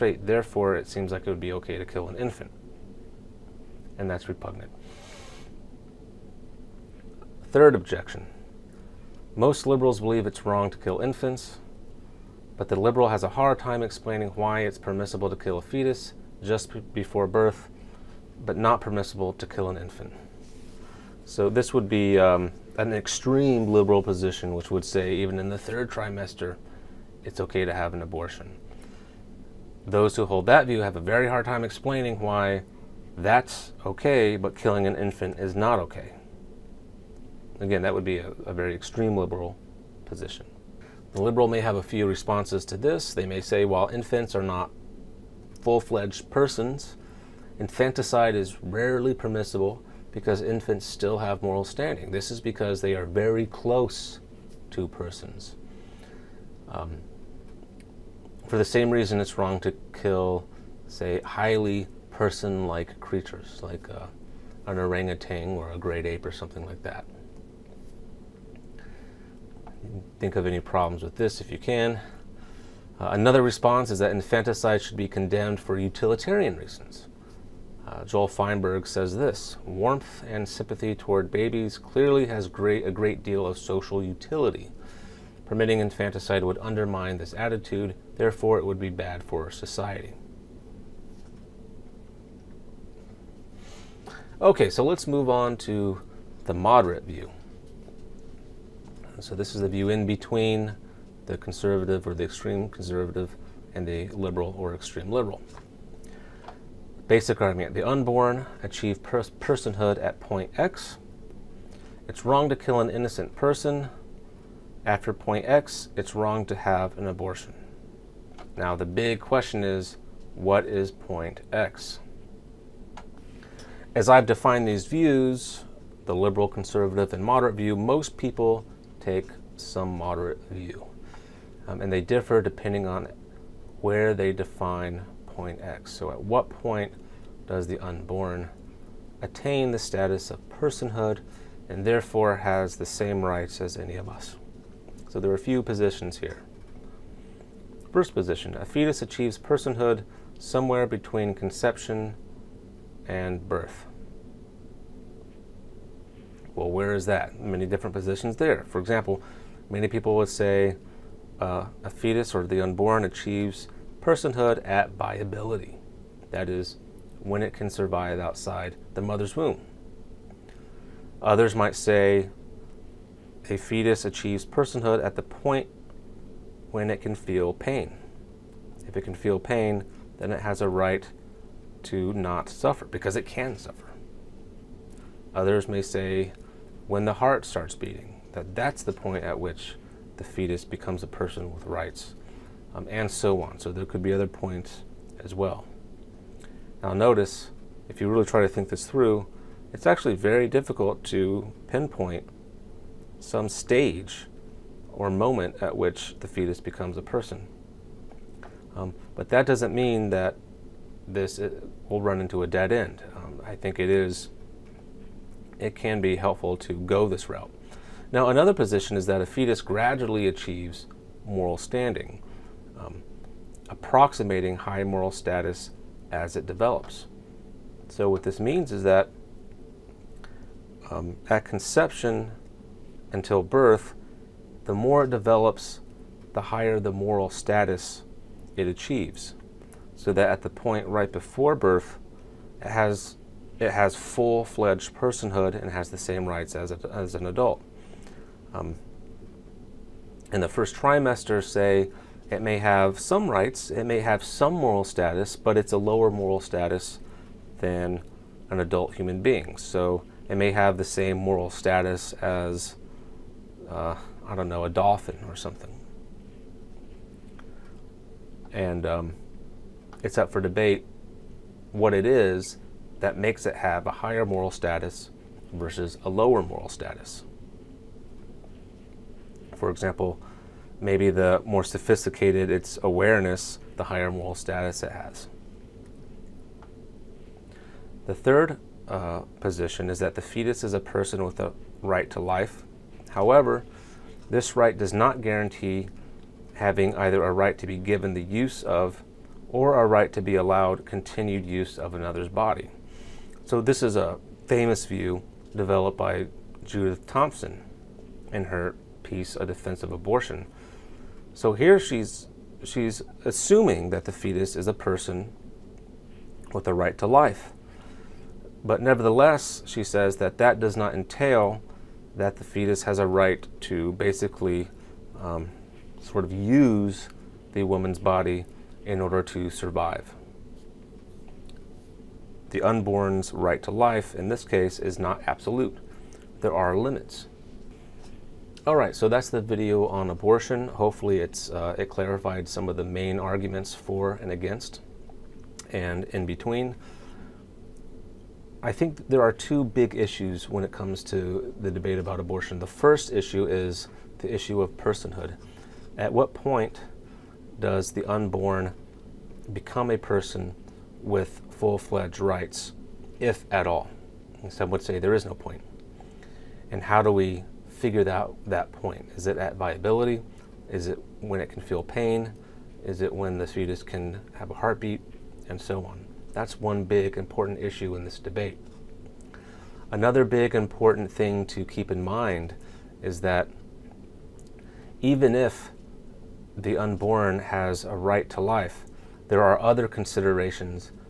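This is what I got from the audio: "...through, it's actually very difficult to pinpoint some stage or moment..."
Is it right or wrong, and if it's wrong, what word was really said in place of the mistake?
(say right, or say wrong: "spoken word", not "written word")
right.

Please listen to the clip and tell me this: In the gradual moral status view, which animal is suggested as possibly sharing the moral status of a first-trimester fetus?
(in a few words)
Dolphin.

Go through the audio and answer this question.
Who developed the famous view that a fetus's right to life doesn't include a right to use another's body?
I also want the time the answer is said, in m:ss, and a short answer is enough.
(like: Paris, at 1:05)
Judith Thomson, at 5:06.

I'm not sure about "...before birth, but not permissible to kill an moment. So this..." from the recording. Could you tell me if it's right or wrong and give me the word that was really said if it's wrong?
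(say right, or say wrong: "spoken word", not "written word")
wrong: "infant", not "moment".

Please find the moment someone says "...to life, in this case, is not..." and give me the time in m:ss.
5:33.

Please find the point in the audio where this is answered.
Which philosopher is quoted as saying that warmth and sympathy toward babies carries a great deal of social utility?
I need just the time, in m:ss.
1:18.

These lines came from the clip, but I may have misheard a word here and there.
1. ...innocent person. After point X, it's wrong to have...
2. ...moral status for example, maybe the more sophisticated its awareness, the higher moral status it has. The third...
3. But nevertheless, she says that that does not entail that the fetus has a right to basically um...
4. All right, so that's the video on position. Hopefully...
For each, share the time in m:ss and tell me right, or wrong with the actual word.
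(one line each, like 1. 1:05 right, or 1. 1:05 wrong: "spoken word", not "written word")
1. 1:52 right
2. 4:36 right
3. 5:18 right
4. 5:38 wrong: "abortion", not "position".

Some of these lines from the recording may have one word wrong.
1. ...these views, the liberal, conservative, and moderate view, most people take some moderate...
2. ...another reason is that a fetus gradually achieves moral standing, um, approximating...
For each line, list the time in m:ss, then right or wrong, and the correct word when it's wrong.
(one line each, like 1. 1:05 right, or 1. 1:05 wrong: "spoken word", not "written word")
1. 2:04 right
2. 3:38 wrong: "position", not "reason".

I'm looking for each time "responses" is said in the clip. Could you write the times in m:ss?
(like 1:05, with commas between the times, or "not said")
0:42, 1:13.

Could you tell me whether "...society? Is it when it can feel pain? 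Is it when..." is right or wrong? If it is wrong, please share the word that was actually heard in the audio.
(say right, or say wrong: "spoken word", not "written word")
wrong: "viability", not "society".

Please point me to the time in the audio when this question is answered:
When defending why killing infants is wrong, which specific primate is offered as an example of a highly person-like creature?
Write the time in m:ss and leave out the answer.
1:04.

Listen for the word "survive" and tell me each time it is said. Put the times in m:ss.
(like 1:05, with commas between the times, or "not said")
2:47, 5:29.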